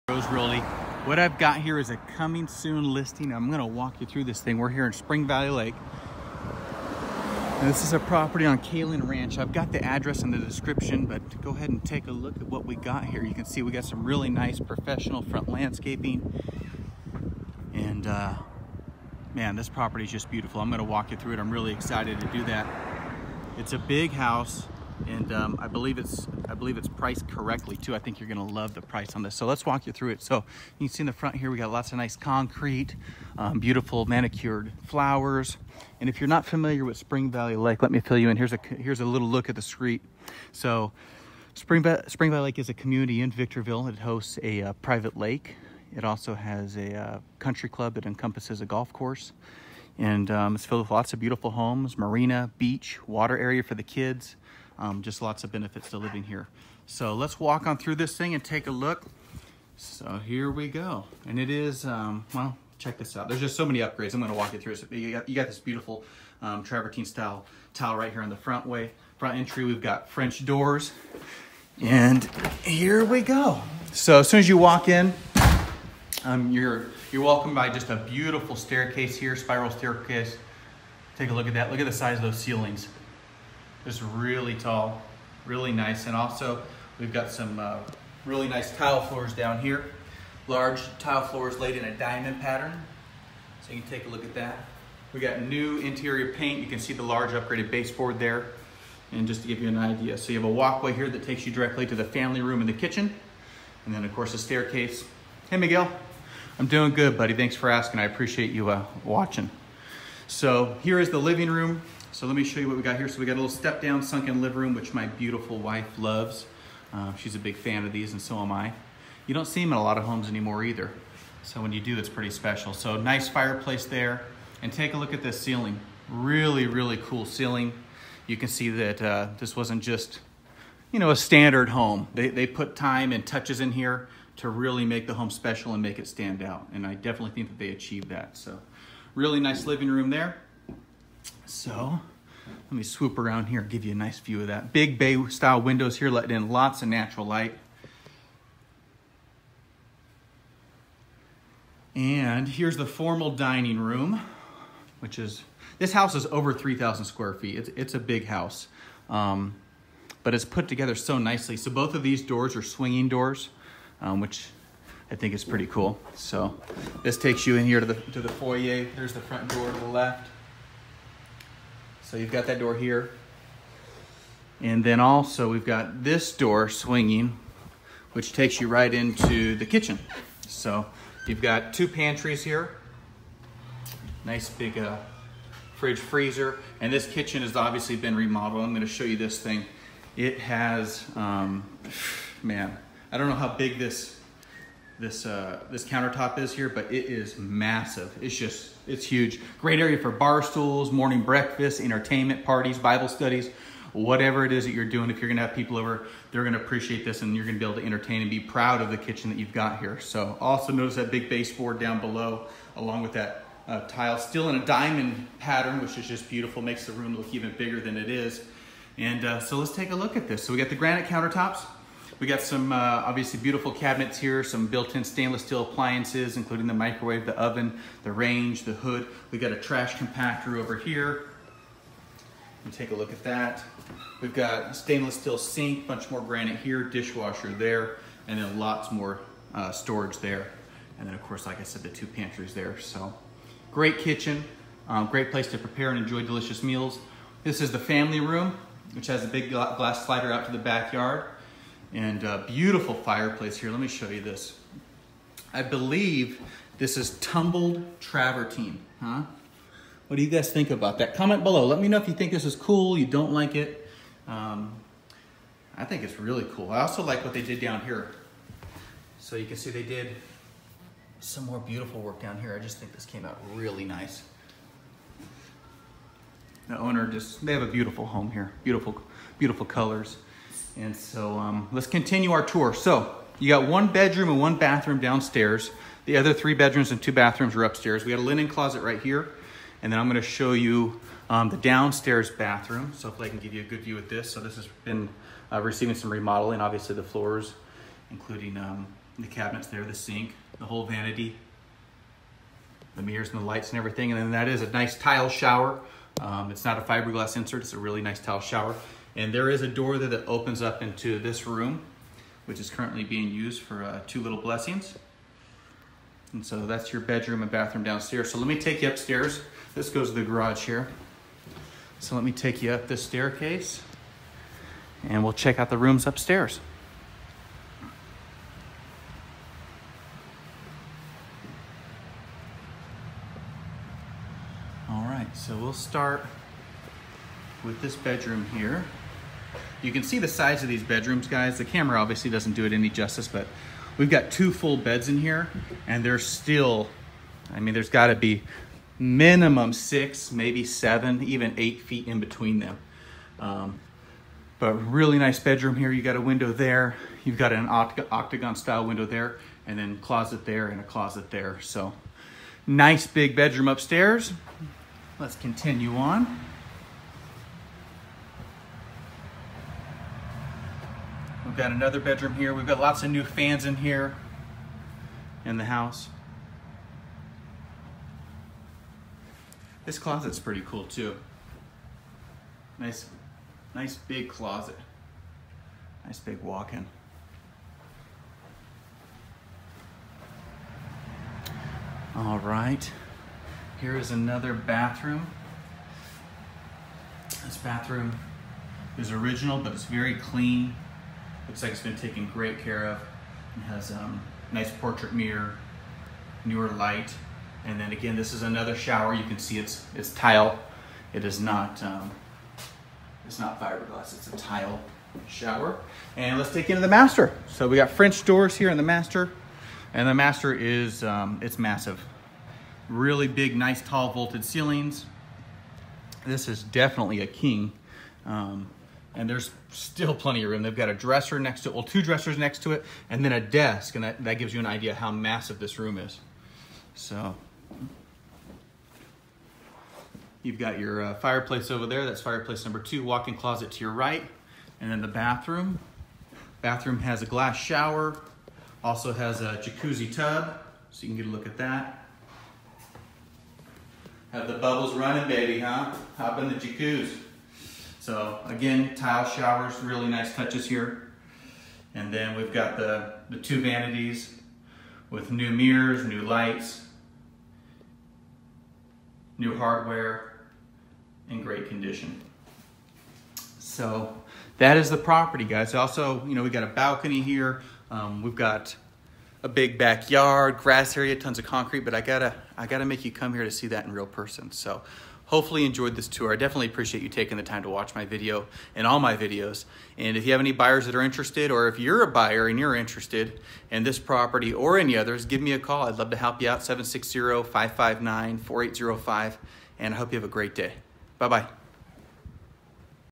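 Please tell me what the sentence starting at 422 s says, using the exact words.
Really big, nice, tall vaulted ceilings.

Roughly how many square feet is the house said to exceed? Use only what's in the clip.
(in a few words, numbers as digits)
3,000.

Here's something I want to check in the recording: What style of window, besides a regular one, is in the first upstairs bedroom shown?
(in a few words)
Octagon.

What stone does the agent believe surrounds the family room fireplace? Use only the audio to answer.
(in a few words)
Tumbled travertine.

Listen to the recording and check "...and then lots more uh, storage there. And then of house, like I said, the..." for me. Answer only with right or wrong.
wrong.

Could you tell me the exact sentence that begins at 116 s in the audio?
Uh, she's a big fan of these and so am I.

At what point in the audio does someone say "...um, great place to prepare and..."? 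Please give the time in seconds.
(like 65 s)
244 s.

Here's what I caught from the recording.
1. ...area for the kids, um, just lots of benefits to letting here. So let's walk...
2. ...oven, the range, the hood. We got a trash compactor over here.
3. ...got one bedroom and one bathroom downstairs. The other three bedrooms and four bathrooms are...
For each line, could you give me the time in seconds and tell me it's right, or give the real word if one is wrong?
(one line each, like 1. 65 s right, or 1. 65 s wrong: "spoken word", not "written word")
1. 53 s wrong: "living", not "letting"
2. 227 s right
3. 283 s wrong: "two", not "four".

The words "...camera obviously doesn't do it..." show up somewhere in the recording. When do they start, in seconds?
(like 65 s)
341 s.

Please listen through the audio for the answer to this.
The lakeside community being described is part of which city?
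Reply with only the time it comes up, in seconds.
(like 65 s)
43 s.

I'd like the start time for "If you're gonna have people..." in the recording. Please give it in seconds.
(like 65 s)
205 s.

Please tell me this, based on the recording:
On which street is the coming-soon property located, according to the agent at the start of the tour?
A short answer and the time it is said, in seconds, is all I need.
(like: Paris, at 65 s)
Kalin Ranch, at 8 s.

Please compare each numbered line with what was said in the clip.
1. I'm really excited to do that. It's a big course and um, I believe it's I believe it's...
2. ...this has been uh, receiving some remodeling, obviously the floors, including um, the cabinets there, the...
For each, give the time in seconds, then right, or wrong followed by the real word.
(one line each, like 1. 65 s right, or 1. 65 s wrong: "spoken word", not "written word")
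1. 21 s wrong: "house", not "course"
2. 294 s right.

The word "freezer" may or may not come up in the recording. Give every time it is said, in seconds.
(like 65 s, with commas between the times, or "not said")
185 s.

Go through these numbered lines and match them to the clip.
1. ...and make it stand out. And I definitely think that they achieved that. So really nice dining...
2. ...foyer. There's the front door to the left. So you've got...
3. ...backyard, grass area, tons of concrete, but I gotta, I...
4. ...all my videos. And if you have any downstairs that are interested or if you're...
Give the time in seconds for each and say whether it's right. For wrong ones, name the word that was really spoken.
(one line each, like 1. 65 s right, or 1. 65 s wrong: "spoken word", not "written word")
1. 135 s wrong: "living", not "dining"
2. 168 s right
3. 479 s right
4. 488 s wrong: "buyers", not "downstairs".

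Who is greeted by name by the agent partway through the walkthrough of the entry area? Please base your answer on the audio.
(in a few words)
Miguel.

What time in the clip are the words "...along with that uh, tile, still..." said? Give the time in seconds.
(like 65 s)
212 s.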